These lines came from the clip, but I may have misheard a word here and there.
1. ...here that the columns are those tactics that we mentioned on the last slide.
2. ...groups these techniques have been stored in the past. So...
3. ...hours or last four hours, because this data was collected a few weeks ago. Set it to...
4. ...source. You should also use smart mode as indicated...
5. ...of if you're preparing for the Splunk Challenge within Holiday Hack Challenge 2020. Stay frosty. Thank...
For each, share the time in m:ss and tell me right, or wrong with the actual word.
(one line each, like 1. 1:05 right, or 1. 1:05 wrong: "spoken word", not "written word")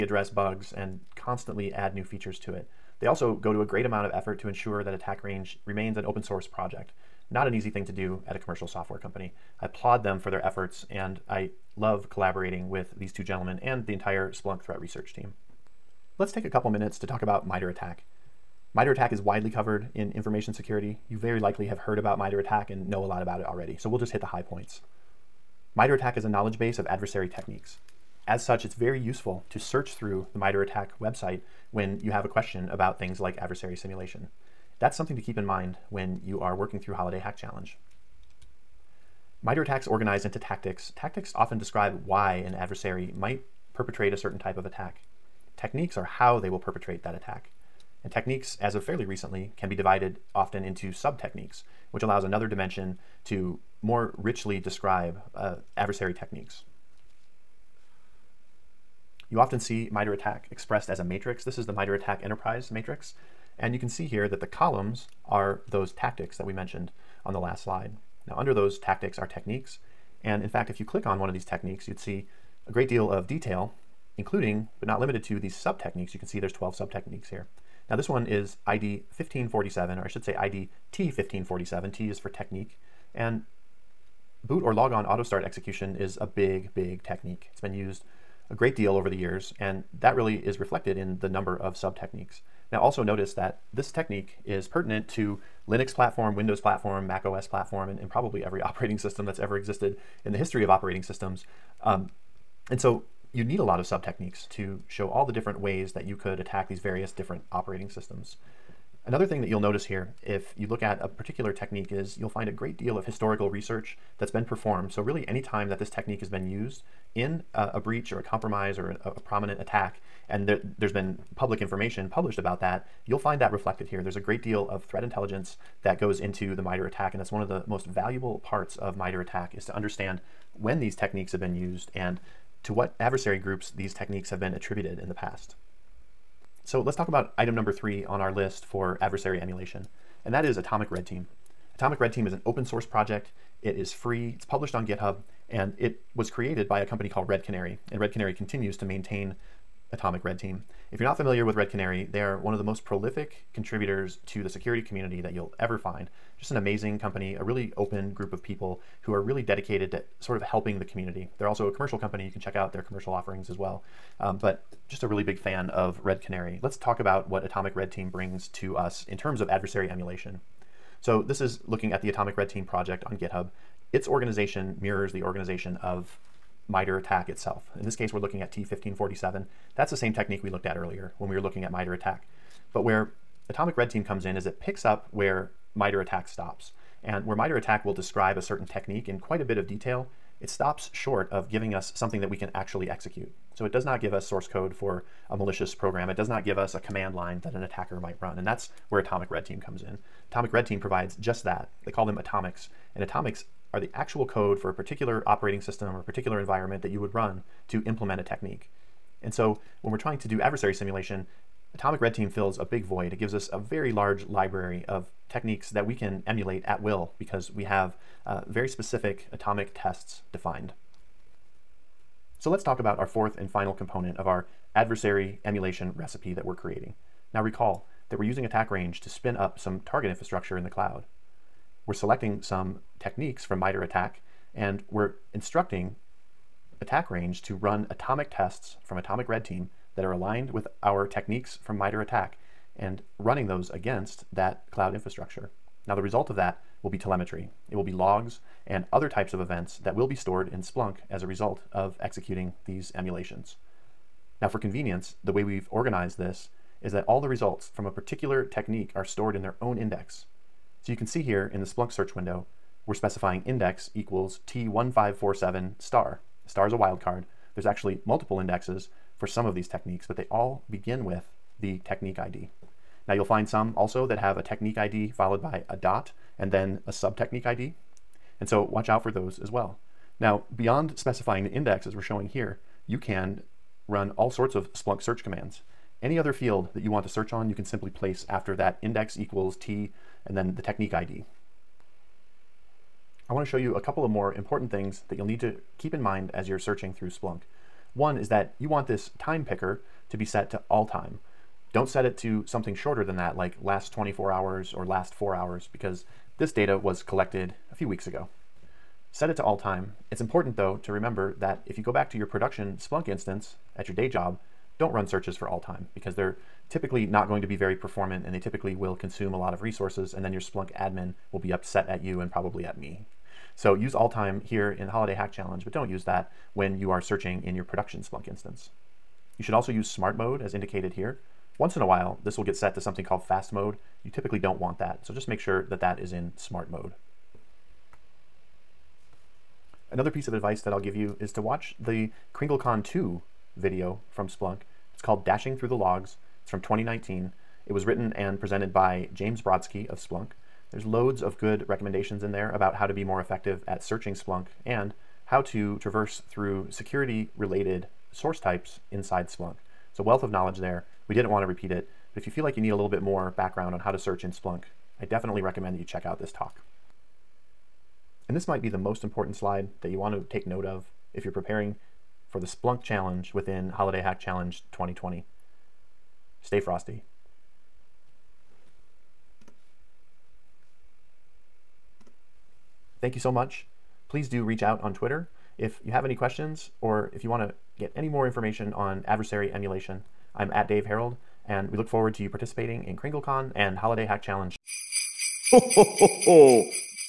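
1. 1:04 right
2. 2:13 wrong: "attributed", not "stored"
3. 5:04 right
4. 5:28 wrong: "instance", not "source"
5. 6:10 right.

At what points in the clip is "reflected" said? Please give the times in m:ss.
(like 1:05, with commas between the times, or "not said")
1:30, 2:03.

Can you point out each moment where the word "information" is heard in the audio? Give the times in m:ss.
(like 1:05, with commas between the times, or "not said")
0:20, 2:01, 6:28.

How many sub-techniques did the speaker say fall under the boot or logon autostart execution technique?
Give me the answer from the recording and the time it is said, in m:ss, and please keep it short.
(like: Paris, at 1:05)
12, at 1:16.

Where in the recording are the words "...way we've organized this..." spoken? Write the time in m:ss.
4:15.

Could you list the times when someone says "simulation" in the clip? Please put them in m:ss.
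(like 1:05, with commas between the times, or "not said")
0:33, 3:30.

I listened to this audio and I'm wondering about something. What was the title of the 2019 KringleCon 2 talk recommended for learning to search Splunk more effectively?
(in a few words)
Dashing Through the Logs.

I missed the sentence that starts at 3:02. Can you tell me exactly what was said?
But where Atomic Red Team comes in is it picks up where MITRE ATT&CK stops.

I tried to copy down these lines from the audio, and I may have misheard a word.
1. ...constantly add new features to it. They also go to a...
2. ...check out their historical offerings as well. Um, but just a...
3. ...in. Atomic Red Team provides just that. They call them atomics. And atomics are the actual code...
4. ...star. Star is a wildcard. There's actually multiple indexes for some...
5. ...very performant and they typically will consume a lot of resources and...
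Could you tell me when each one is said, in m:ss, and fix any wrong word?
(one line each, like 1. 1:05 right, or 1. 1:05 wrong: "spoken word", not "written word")
1. 0:01 right
2. 2:42 wrong: "commercial", not "historical"
3. 3:19 right
4. 4:25 right
5. 5:17 right.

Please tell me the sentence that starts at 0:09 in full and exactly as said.
I applaud them for their efforts and I love collaborating with these two gentlemen and the entire Splunk threat research team.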